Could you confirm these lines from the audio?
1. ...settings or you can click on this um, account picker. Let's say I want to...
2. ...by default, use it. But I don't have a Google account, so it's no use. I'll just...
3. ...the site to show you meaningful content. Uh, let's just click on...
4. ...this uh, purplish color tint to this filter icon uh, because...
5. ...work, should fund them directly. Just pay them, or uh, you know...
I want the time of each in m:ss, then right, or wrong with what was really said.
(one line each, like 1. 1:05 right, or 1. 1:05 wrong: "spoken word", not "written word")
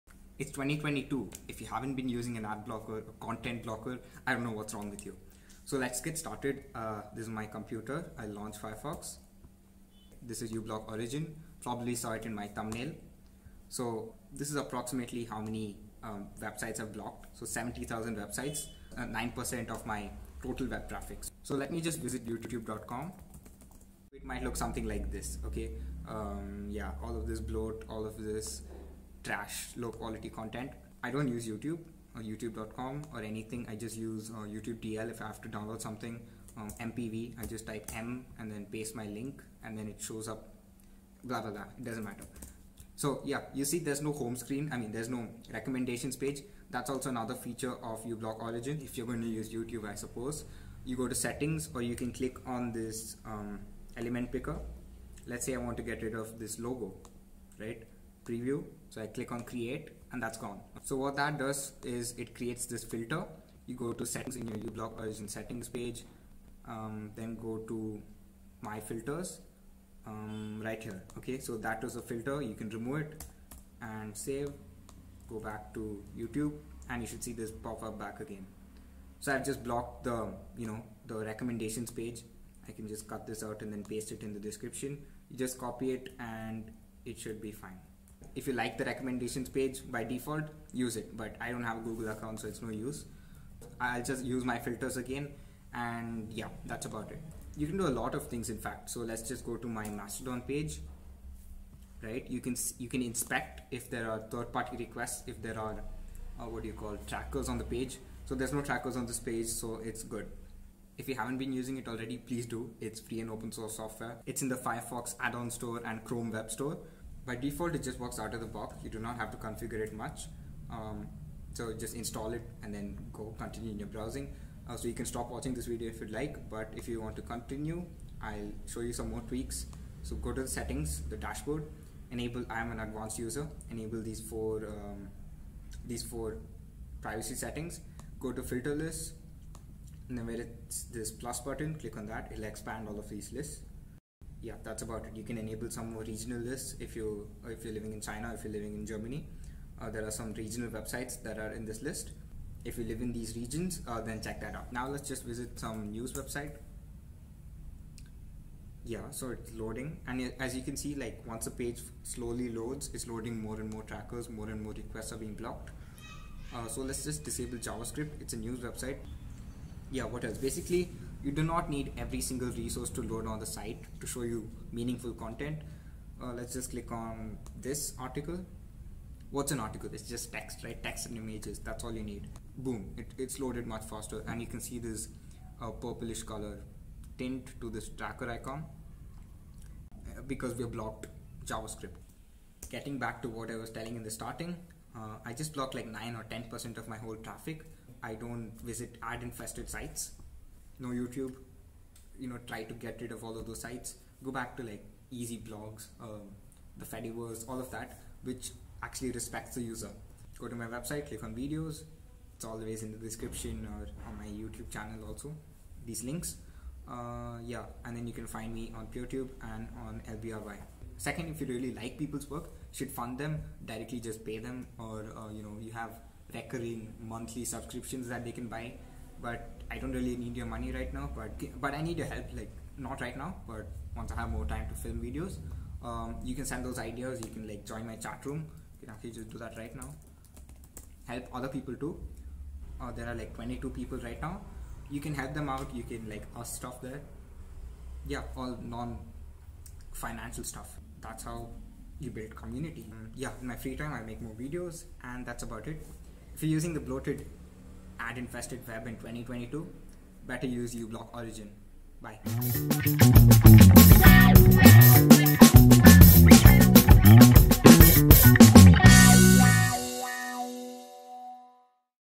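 1. 0:51 wrong: "element", not "account"
2. 1:29 right
3. 2:53 right
4. 3:04 wrong: "tracker", not "filter"
5. 3:42 right.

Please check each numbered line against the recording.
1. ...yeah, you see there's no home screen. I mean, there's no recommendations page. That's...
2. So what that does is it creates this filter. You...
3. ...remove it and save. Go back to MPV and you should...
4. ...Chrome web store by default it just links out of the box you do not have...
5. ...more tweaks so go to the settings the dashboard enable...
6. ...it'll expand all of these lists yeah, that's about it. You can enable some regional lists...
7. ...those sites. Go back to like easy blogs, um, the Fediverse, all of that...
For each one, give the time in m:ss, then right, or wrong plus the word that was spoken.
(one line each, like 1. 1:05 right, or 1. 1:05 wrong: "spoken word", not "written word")
1. 0:43 right
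2. 1:00 right
3. 1:12 wrong: "YouTube", not "MPV"
4. 1:56 wrong: "works", not "links"
5. 2:09 right
6. 2:22 right
7. 3:23 right.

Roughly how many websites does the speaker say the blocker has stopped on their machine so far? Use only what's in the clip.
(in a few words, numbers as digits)
70,000.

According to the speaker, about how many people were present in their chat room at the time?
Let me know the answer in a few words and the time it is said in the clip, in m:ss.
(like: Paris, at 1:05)
22, at 4:03.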